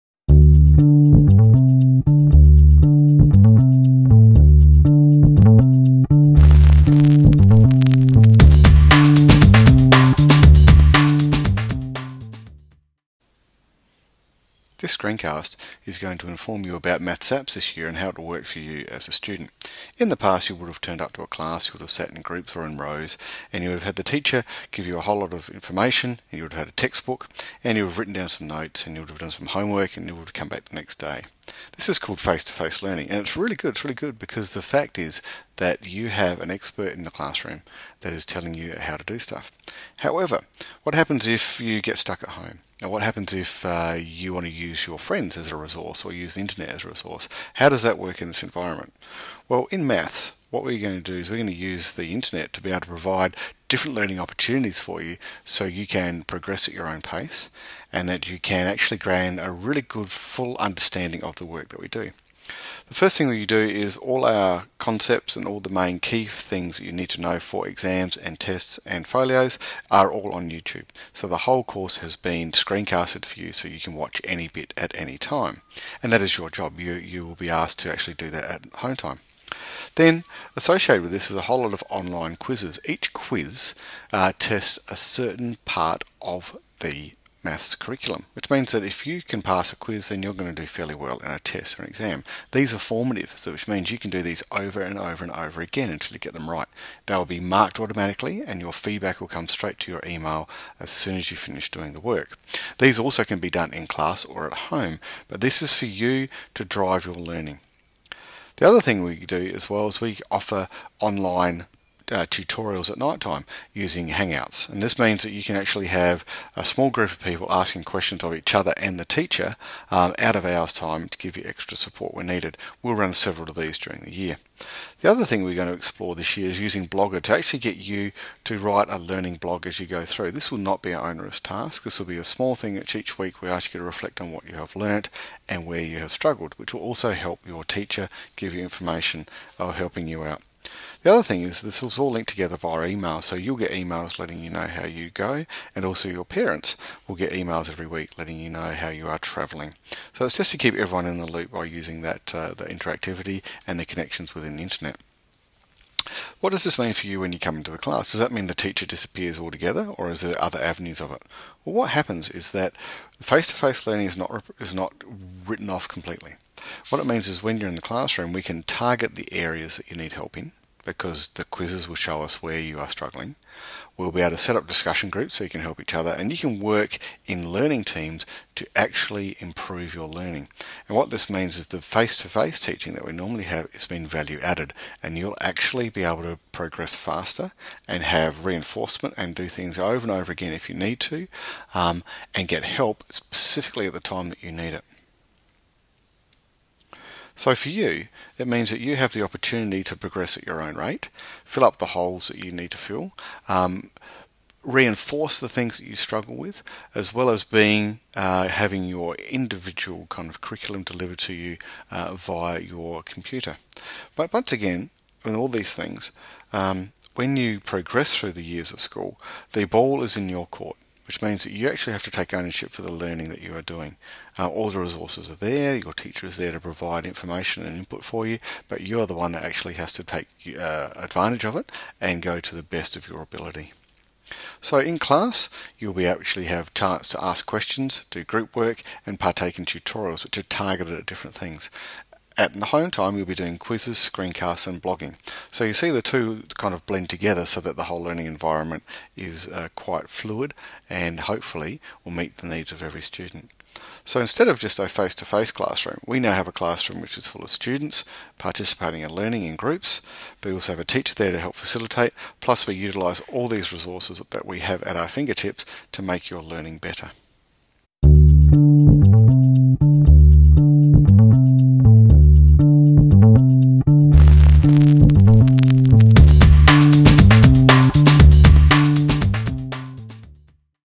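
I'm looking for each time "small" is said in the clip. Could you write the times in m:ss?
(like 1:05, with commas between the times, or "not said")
1:56, 2:12.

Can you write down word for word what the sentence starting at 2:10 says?
This will not be an onerous task.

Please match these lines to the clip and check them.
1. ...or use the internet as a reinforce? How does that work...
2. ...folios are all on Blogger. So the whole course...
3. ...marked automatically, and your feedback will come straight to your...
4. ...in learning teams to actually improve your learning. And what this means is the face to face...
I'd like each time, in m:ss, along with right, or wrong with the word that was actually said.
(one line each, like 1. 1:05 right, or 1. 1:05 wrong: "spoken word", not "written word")
1. 0:46 wrong: "resource", not "reinforce"
2. 1:09 wrong: "YouTube", not "Blogger"
3. 1:37 right
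4. 2:57 right.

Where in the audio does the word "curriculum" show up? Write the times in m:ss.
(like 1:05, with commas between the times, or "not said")
1:27, 3:30.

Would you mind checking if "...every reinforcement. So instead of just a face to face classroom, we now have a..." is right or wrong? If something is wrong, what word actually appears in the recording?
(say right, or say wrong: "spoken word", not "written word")
wrong: "student", not "reinforcement".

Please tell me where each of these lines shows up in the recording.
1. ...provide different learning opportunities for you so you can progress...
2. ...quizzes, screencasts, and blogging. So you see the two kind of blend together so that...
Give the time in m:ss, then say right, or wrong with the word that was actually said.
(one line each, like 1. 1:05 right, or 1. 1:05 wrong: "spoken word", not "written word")
1. 0:52 right
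2. 4:03 right.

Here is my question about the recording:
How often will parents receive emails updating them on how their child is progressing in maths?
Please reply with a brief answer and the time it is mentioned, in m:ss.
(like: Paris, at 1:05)
Every week, at 2:27.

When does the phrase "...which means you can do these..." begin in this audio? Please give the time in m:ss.
1:33.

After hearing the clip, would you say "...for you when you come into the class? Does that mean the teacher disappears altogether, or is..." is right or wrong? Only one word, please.
right.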